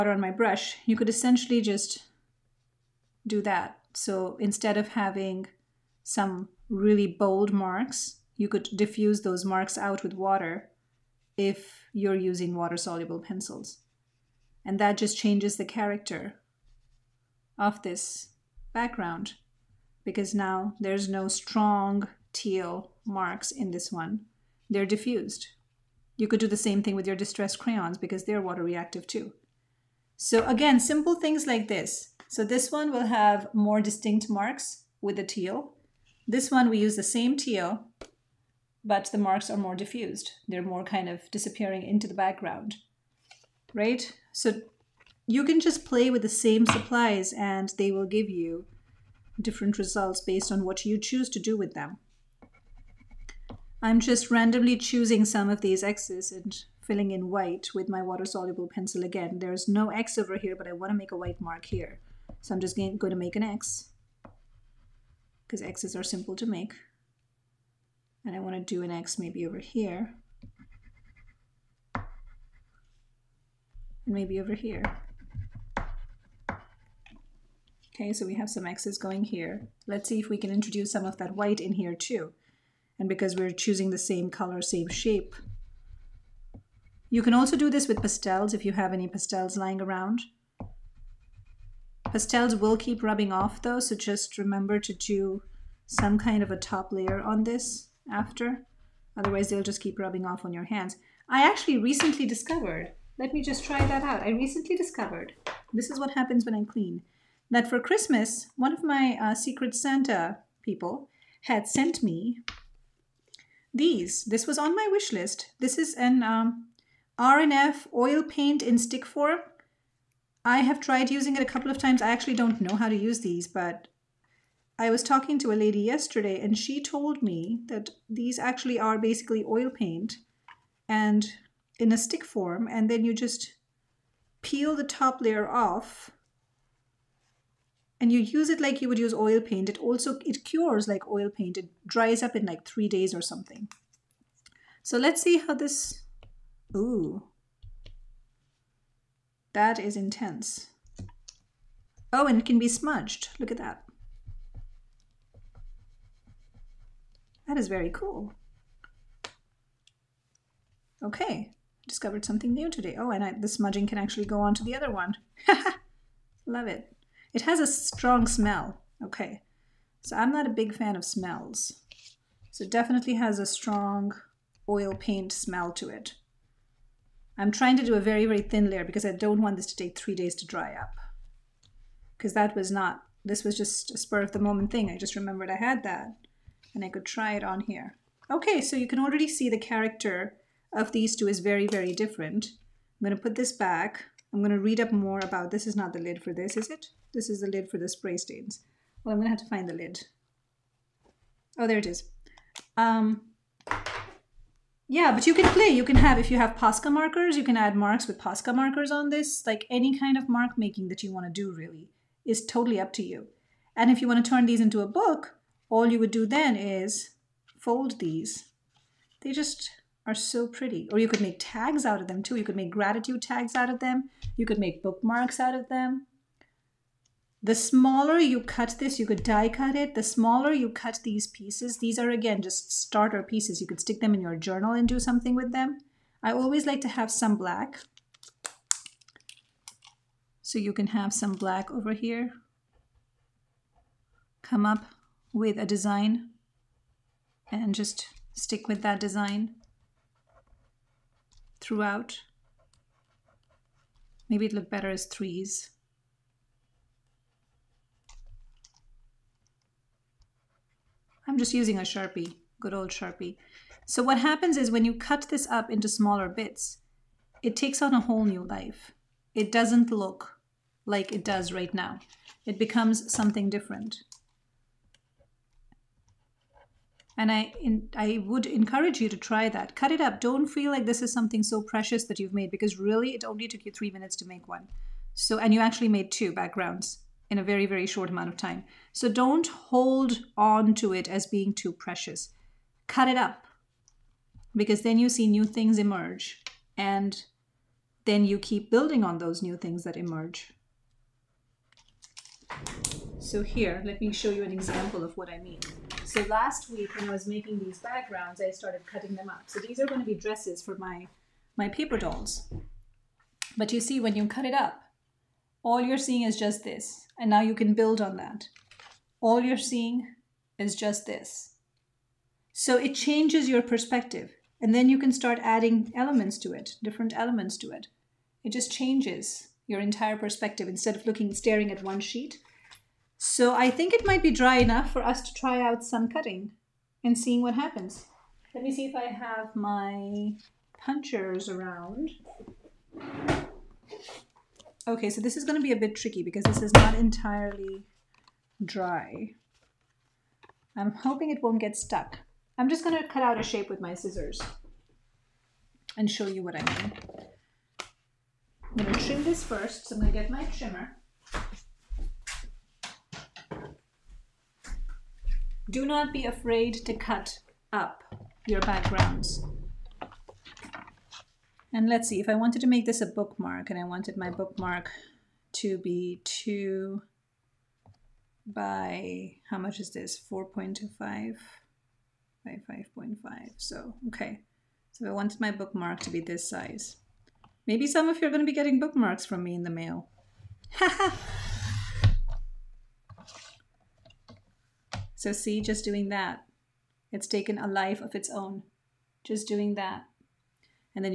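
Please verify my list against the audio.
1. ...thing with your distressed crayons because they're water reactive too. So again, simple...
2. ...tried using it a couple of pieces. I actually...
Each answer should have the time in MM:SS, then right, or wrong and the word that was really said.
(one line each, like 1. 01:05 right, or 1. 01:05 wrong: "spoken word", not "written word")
1. 00:26 right
2. 02:00 wrong: "times", not "pieces".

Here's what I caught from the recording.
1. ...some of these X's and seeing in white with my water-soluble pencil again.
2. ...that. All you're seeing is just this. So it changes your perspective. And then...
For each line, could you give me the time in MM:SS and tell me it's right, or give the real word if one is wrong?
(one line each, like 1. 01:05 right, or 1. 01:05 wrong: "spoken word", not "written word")
1. 00:55 wrong: "filling", not "seeing"
2. 05:18 right.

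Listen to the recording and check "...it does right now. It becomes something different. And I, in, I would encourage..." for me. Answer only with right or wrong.
right.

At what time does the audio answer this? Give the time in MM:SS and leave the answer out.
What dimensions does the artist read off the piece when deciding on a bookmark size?
06:20.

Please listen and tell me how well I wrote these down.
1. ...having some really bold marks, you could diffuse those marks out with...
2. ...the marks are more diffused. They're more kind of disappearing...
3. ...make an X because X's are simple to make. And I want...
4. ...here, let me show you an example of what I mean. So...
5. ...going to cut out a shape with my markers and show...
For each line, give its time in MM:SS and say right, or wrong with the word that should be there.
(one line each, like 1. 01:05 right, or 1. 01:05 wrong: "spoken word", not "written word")
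1. 00:04 right
2. 00:39 right
3. 01:03 right
4. 05:03 right
5. 05:52 wrong: "scissors", not "markers".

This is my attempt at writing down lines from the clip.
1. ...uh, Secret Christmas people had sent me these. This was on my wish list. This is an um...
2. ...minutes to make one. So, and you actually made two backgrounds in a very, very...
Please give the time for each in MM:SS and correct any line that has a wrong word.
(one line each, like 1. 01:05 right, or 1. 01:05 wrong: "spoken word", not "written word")
1. 01:49 wrong: "Santa", not "Christmas"
2. 04:43 right.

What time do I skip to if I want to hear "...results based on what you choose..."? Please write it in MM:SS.
00:49.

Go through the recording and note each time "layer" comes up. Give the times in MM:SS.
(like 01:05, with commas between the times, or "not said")
01:36, 02:15, 02:58.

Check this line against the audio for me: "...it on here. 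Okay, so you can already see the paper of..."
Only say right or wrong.
wrong.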